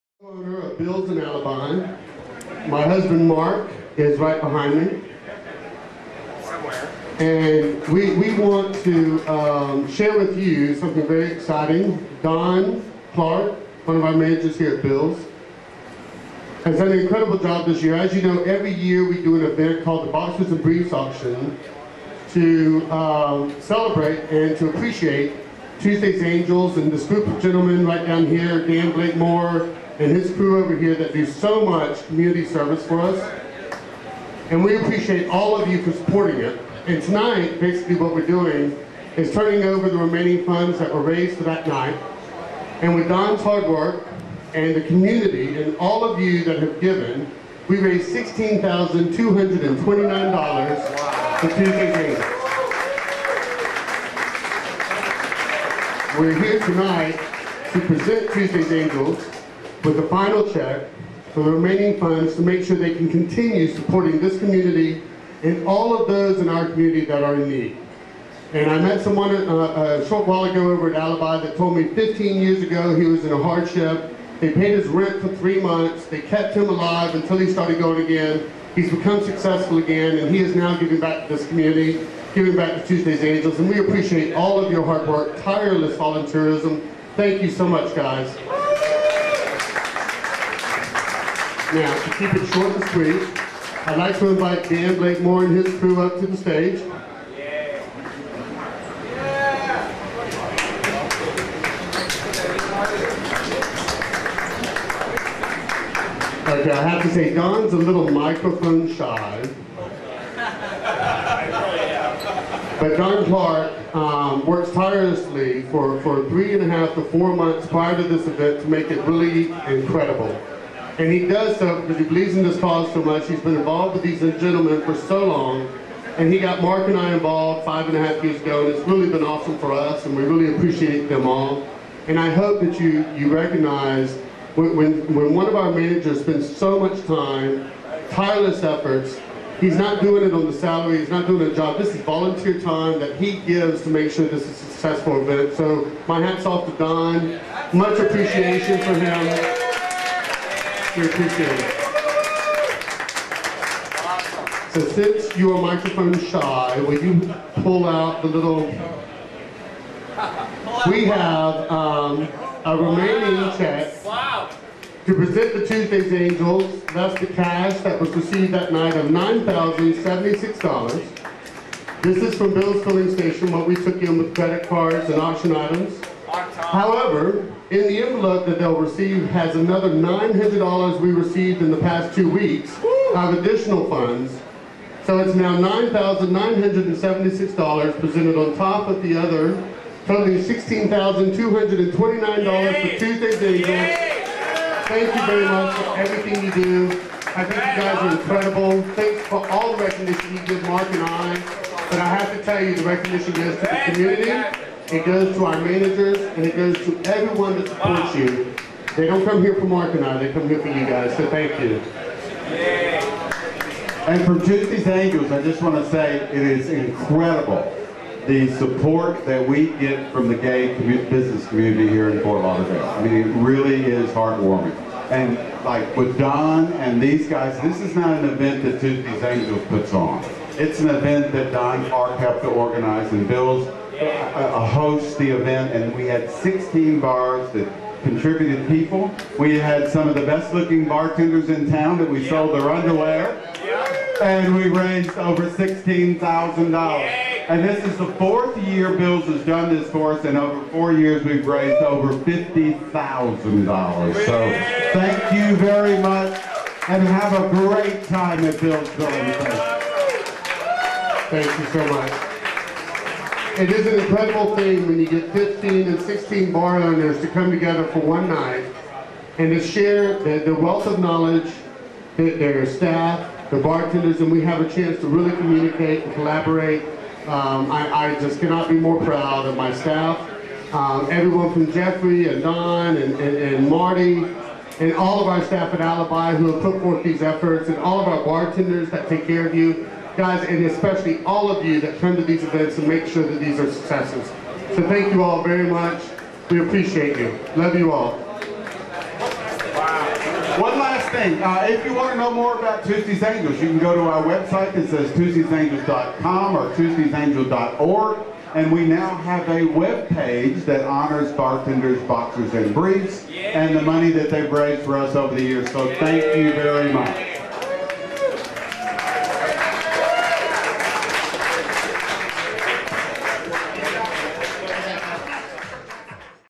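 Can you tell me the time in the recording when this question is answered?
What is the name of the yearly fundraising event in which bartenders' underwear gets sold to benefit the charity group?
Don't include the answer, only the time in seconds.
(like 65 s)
20 s.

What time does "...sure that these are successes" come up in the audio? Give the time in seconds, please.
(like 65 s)
293 s.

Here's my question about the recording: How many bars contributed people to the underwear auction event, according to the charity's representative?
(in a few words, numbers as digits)
16.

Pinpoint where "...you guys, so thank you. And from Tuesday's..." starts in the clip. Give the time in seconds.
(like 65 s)
210 s.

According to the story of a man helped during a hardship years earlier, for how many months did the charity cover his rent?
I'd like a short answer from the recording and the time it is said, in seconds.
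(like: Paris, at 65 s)
3, at 75 s.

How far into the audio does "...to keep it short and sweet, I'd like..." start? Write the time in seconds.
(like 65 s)
92 s.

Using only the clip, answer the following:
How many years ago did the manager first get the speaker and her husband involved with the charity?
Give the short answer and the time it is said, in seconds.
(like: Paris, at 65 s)
5 and a half, at 127 s.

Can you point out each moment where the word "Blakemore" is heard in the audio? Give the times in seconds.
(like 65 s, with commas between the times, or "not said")
28 s, 94 s.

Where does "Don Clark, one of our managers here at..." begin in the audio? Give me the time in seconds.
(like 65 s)
12 s.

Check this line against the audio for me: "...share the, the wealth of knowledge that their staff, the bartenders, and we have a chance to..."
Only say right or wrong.
right.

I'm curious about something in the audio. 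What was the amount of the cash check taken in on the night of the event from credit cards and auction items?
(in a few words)
$9,076.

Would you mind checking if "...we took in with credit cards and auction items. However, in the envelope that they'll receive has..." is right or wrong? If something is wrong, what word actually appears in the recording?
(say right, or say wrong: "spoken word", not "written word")
right.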